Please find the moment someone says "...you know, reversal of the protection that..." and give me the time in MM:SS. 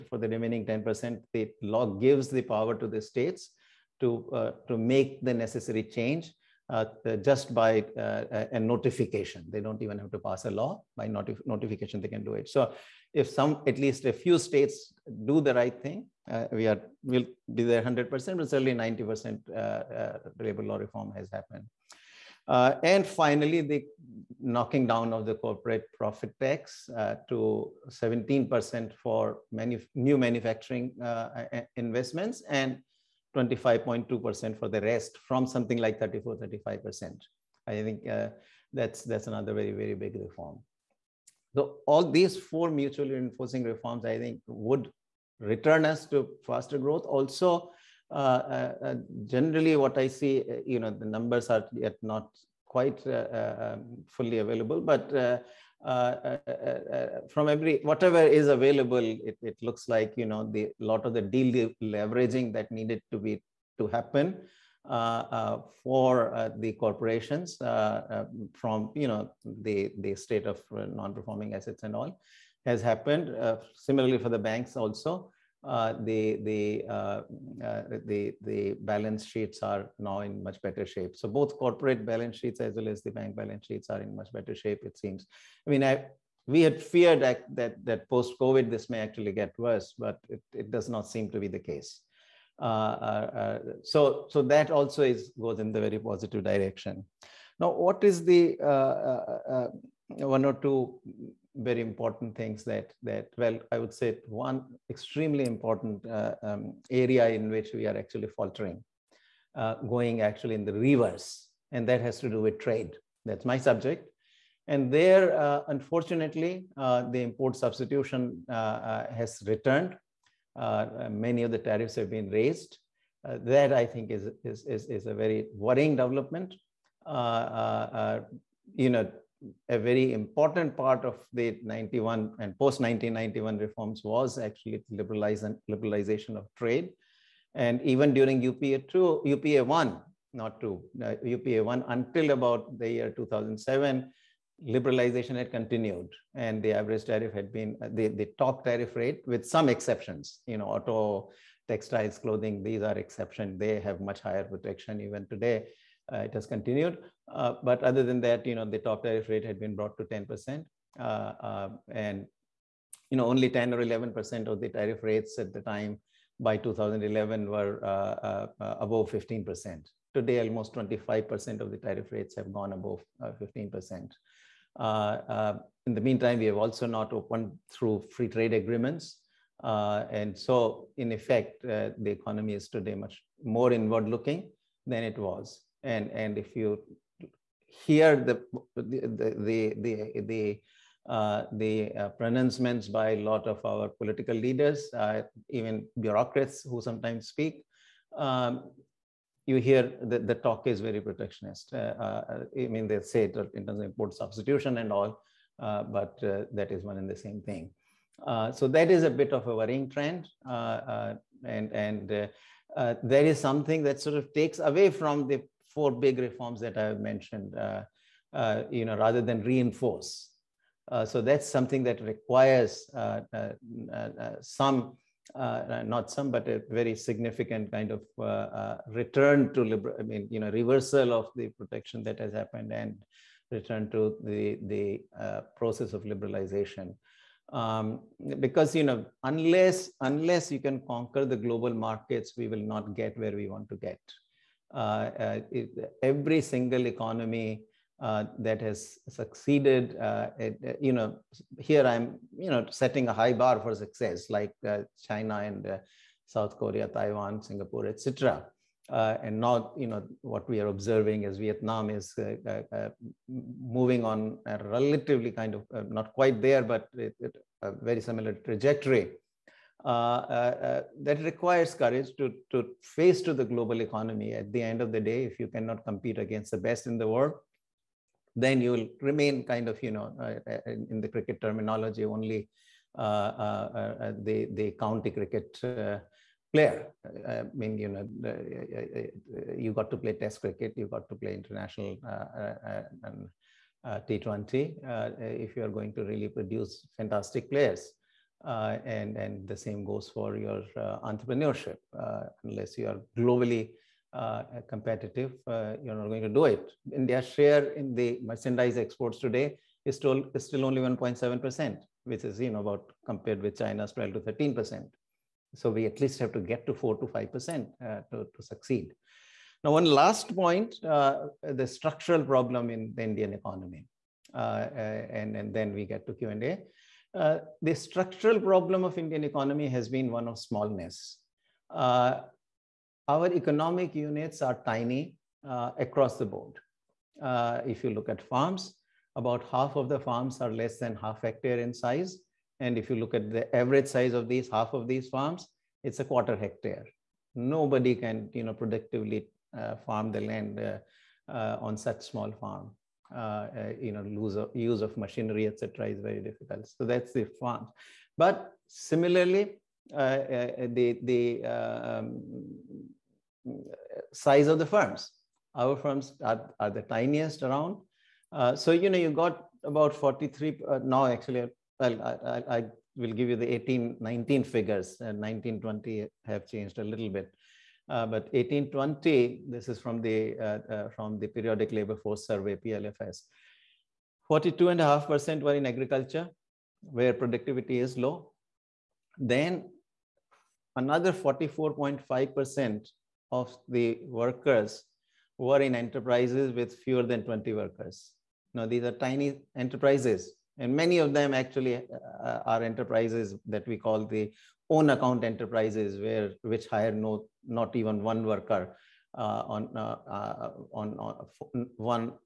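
03:50.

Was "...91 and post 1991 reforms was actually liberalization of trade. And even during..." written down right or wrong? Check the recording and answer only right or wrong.
right.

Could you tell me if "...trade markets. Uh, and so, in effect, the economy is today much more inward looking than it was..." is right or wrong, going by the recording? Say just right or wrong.
wrong.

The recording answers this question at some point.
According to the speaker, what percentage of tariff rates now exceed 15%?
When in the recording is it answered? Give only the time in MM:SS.
02:50.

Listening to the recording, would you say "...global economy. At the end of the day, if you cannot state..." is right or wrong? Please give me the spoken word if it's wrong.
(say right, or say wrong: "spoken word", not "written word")
wrong: "compete", not "state".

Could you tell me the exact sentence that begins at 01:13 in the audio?
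similarly for the banks also the, uh, the, the, uh, uh, the balance sheets are now in much better shape.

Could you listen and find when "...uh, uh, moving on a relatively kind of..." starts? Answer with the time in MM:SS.
04:22.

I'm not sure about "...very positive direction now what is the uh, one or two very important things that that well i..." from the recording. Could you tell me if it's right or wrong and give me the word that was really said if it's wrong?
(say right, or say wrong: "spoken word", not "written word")
right.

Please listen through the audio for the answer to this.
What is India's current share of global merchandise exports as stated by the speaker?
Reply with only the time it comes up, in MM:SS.
05:10.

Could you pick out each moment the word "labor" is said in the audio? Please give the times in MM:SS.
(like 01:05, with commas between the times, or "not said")
00:20, 06:21.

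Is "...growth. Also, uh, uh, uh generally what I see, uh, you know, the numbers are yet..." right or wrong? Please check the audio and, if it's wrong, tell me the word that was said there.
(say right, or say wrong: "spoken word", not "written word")
right.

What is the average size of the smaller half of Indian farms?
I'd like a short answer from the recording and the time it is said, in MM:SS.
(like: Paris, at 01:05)
a quarter hectare, at 05:45.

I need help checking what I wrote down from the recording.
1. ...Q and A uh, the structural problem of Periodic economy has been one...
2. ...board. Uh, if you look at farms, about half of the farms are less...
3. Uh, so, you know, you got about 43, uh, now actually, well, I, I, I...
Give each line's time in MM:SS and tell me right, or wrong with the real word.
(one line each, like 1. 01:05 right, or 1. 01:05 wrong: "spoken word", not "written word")
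1. 05:26 wrong: "Indian", not "Periodic"
2. 05:36 right
3. 06:08 right.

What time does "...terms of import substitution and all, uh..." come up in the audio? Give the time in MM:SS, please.
03:23.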